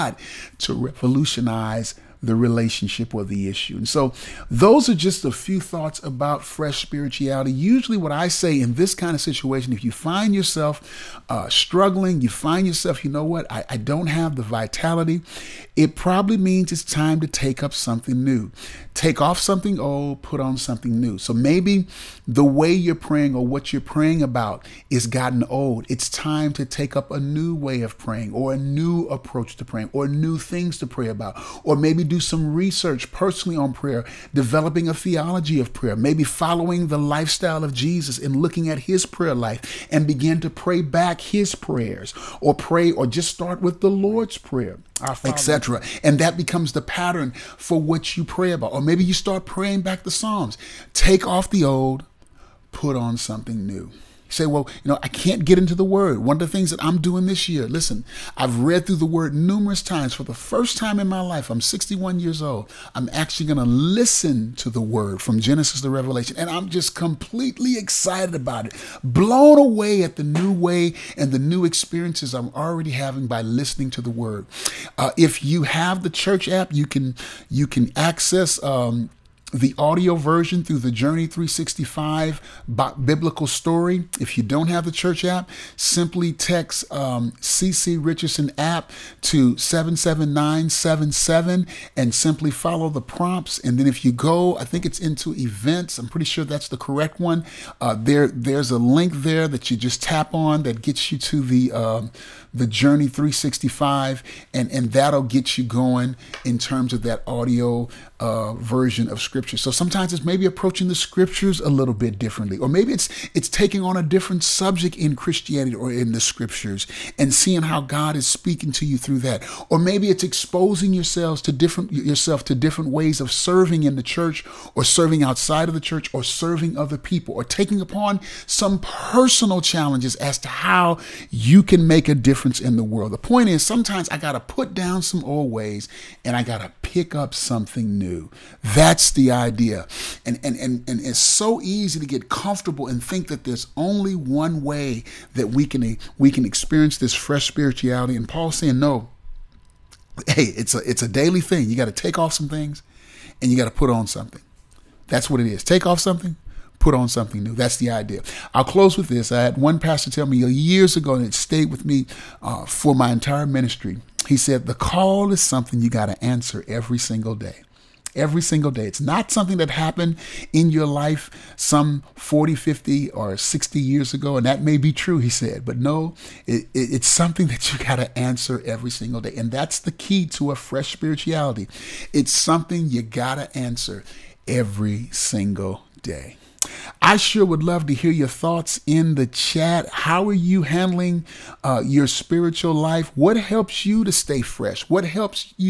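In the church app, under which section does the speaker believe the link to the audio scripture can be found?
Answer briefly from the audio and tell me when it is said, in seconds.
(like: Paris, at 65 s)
Events, at 95 s.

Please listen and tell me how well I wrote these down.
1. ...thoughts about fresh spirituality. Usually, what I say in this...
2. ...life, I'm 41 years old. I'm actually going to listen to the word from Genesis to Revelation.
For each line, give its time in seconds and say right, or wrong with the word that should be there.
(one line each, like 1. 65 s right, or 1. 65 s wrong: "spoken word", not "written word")
1. 5 s right
2. 61 s wrong: "61", not "41".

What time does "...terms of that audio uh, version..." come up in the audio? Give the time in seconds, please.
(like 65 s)
106 s.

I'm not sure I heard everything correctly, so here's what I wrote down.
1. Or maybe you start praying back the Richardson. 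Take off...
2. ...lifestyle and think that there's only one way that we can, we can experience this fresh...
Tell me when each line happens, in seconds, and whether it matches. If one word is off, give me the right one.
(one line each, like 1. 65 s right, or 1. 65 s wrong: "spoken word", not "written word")
1. 48 s wrong: "Psalms", not "Richardson"
2. 142 s wrong: "comfortable", not "lifestyle".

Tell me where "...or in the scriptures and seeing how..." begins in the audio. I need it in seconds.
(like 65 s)
115 s.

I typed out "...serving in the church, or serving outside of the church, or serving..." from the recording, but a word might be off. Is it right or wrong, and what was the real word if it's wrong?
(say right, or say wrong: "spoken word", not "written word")
right.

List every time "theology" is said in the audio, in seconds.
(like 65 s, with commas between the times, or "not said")
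34 s.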